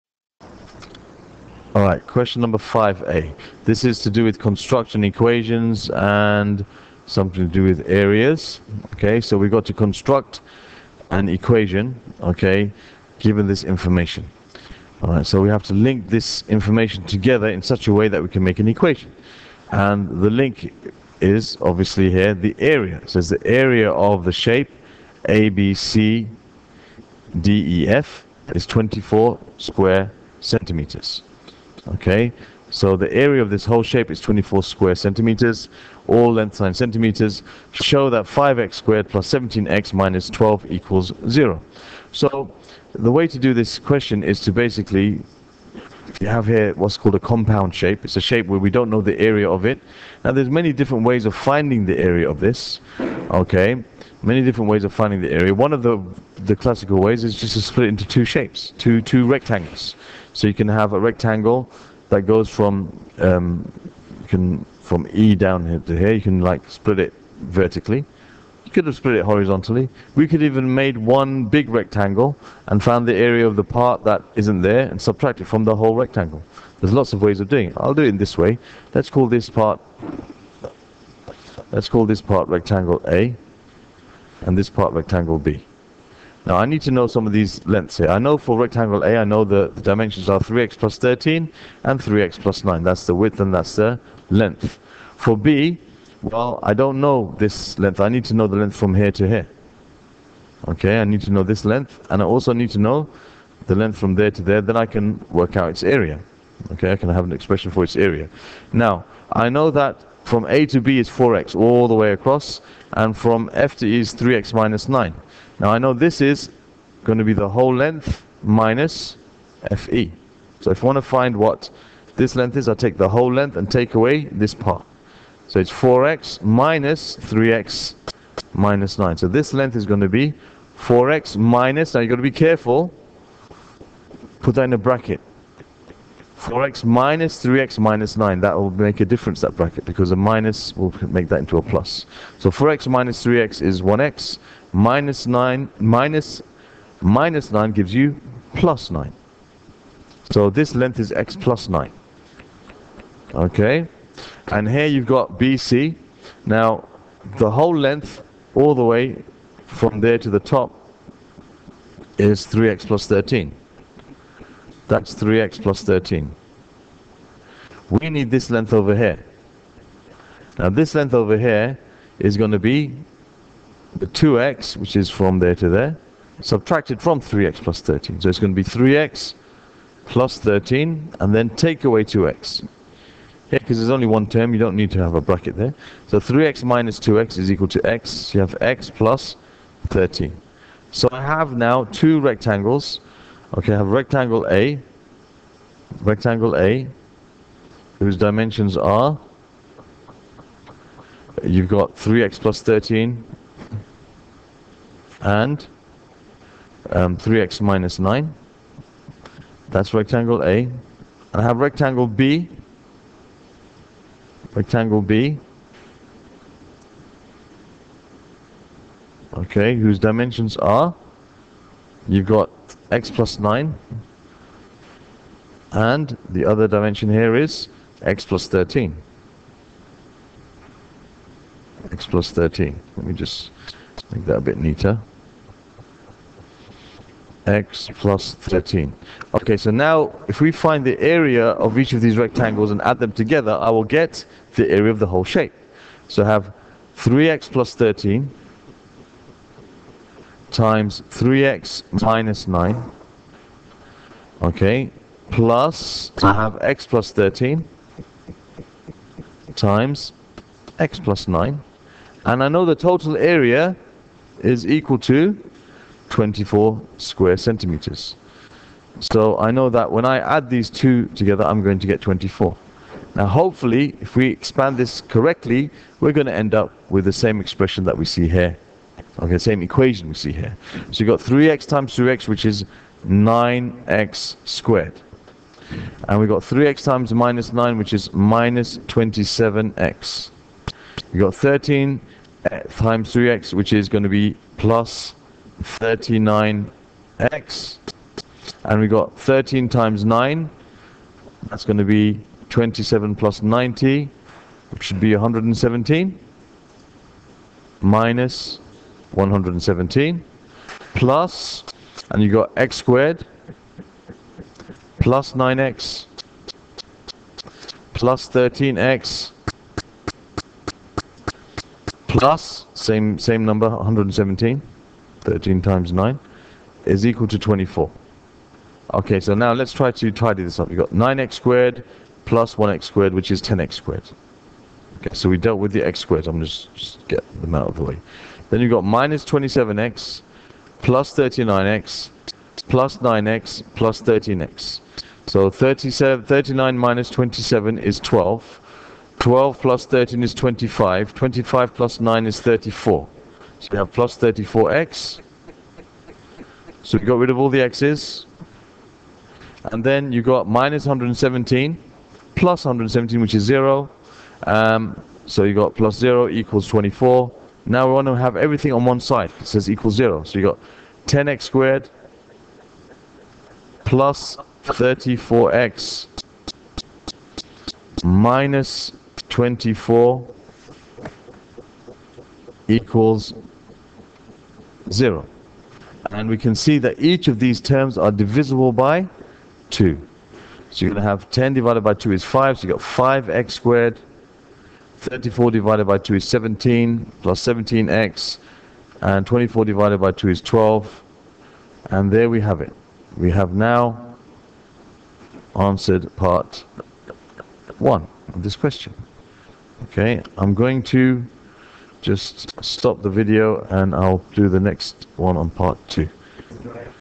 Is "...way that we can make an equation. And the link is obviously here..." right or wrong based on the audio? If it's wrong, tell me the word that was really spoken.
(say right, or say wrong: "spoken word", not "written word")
right.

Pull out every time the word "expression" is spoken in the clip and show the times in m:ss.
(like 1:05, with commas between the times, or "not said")
1:47, 4:37.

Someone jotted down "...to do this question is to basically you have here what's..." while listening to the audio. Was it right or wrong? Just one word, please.
right.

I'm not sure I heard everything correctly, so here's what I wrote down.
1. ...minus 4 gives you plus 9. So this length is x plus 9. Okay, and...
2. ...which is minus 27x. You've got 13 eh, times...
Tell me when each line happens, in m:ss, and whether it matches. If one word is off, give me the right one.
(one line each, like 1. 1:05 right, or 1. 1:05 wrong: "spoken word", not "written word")
1. 2:26 wrong: "9", not "4"
2. 4:47 right.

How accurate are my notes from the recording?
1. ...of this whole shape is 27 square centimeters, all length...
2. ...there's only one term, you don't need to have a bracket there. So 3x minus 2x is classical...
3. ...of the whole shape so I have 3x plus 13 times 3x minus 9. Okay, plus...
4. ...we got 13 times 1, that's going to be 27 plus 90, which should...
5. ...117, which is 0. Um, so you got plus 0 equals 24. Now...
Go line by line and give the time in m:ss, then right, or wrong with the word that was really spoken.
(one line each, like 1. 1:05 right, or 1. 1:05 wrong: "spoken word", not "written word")
1. 0:33 wrong: "24", not "27"
2. 3:03 wrong: "equal", not "classical"
3. 4:04 right
4. 4:58 wrong: "9", not "1"
5. 6:02 right.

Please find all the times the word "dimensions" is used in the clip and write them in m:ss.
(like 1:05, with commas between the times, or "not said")
1:29, 3:18, 3:39, 3:46.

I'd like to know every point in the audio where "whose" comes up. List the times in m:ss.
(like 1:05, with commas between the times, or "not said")
3:17, 3:39.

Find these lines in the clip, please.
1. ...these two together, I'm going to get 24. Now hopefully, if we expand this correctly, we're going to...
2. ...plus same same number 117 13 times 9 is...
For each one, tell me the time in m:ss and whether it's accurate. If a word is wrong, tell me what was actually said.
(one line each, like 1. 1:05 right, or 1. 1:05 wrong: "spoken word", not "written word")
1. 4:30 right
2. 5:22 right.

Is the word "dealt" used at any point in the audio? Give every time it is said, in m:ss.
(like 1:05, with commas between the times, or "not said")
5:35.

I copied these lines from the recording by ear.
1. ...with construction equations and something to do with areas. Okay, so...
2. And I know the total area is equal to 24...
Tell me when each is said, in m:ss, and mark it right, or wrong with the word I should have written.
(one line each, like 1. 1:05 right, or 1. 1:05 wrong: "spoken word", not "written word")
1. 0:04 right
2. 4:22 right.